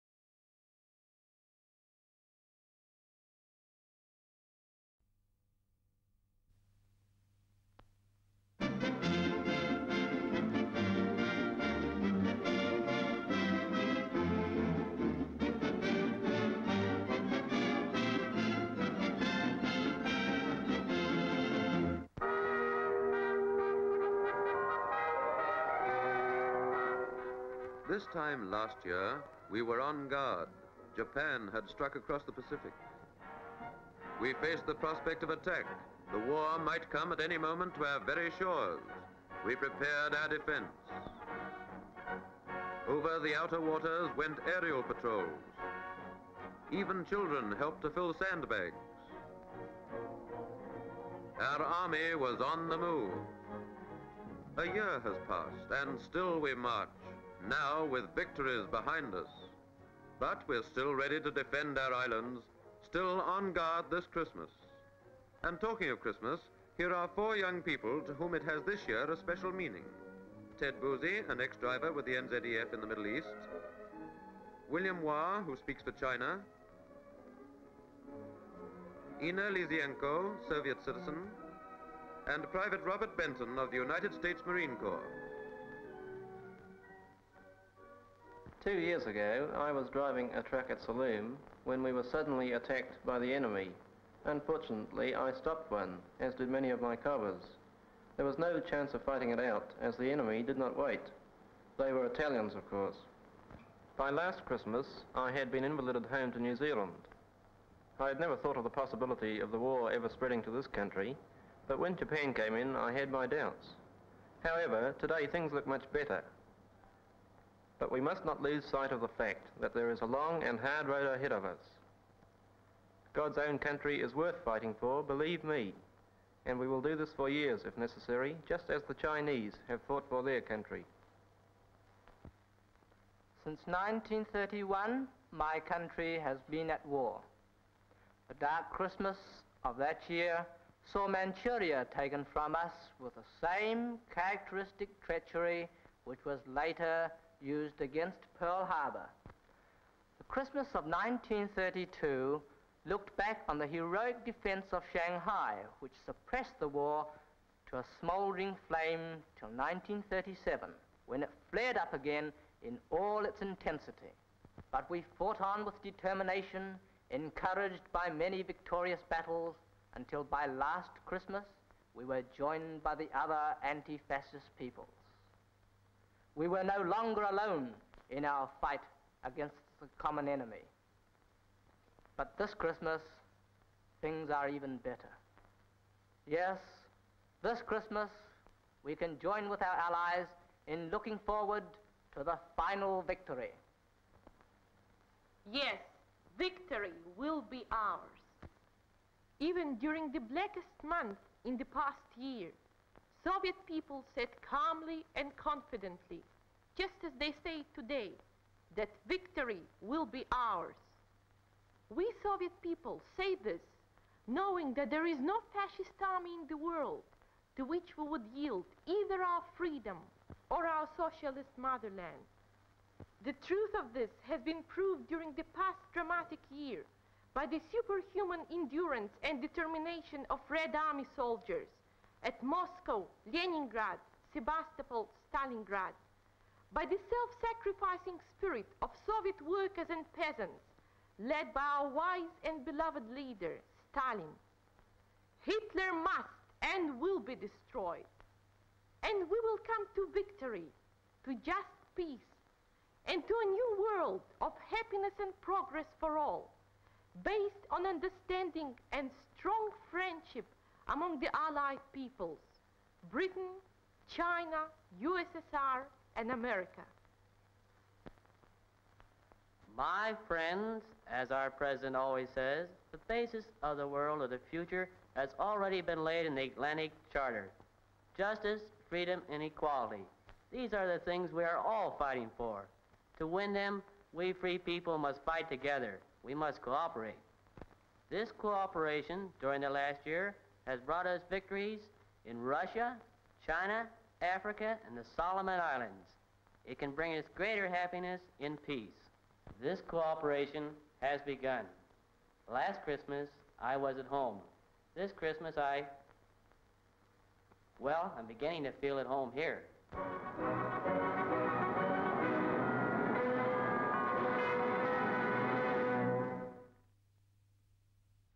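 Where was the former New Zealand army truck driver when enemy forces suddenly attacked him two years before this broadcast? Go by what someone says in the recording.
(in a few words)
Sollum.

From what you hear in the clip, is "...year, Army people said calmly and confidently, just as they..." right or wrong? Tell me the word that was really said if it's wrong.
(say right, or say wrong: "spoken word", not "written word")
wrong: "Soviet", not "Army".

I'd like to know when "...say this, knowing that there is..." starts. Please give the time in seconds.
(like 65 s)
213 s.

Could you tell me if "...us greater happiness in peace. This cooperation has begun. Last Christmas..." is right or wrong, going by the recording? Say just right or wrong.
right.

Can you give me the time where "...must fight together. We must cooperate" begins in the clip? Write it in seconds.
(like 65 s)
284 s.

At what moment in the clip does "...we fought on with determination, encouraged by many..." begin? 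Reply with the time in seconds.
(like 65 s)
164 s.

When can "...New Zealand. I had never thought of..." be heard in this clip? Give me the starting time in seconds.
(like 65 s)
106 s.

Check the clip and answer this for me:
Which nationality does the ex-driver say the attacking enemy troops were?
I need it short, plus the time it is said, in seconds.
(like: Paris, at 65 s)
Italians, at 102 s.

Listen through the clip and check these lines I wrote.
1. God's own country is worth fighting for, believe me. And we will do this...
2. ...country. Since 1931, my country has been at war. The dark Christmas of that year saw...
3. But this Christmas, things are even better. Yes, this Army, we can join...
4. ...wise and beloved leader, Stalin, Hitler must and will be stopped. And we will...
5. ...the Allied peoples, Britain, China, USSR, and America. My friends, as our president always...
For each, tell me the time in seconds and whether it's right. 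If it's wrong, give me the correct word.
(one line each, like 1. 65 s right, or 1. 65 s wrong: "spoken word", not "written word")
1. 123 s right
2. 130 s right
3. 182 s wrong: "Christmas", not "Army"
4. 241 s wrong: "destroyed", not "stopped"
5. 261 s right.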